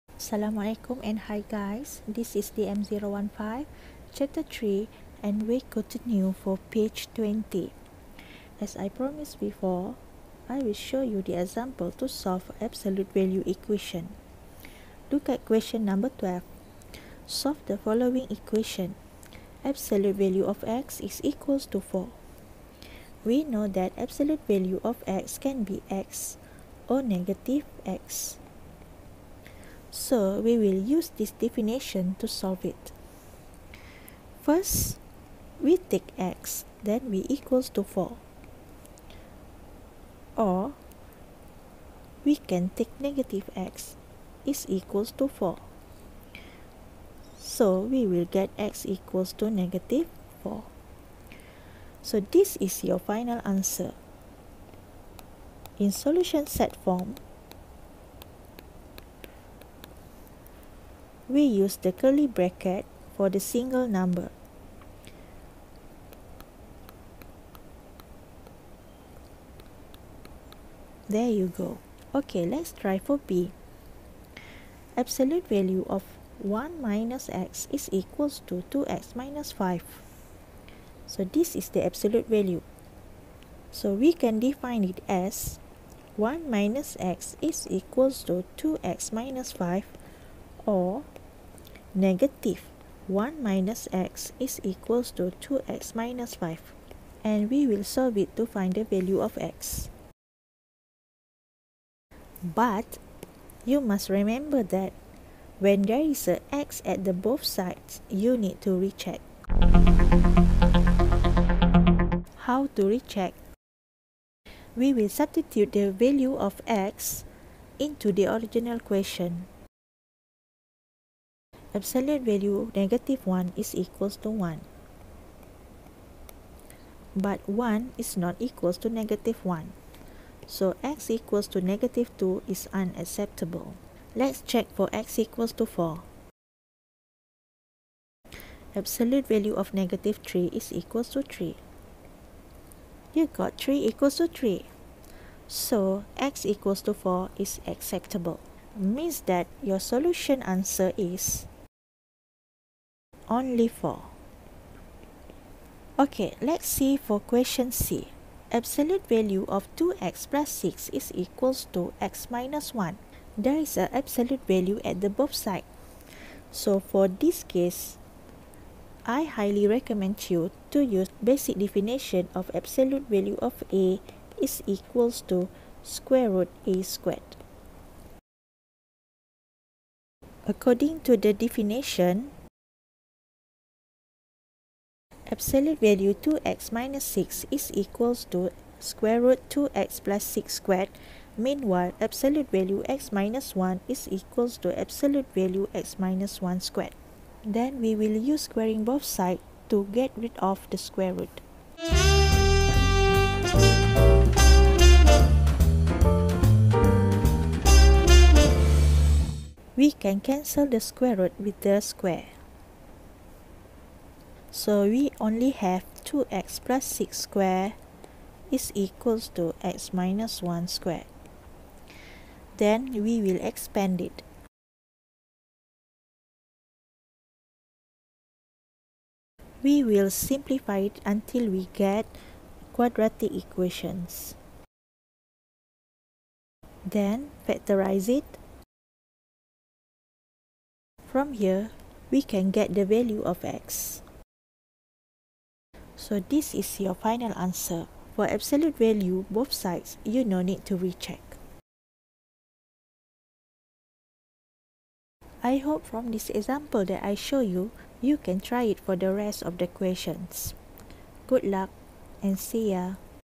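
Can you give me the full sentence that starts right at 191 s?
Meanwhile, absolute value x minus 1 is equals to absolute value x minus 1 squared.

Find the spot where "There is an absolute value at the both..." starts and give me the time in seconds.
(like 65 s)
163 s.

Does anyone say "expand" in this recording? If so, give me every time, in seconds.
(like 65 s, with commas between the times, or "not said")
223 s.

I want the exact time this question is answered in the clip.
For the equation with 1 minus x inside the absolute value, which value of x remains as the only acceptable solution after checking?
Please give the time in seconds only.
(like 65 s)
153 s.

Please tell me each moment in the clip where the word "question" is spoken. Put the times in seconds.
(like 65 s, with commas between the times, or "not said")
15 s, 118 s, 157 s, 259 s.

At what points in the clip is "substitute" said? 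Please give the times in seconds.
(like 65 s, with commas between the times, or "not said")
115 s.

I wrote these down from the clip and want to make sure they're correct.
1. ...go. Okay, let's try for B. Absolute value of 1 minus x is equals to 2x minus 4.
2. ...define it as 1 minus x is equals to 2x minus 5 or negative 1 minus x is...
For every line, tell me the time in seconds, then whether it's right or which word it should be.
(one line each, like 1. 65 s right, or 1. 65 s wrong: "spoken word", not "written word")
1. 71 s wrong: "5", not "4"
2. 84 s right.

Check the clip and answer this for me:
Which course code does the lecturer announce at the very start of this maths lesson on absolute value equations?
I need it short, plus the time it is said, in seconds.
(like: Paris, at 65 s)
DM015, at 2 s.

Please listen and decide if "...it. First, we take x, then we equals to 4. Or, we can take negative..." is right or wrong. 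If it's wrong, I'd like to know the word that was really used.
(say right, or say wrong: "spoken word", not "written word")
right.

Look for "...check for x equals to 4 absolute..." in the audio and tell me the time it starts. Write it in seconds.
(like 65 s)
134 s.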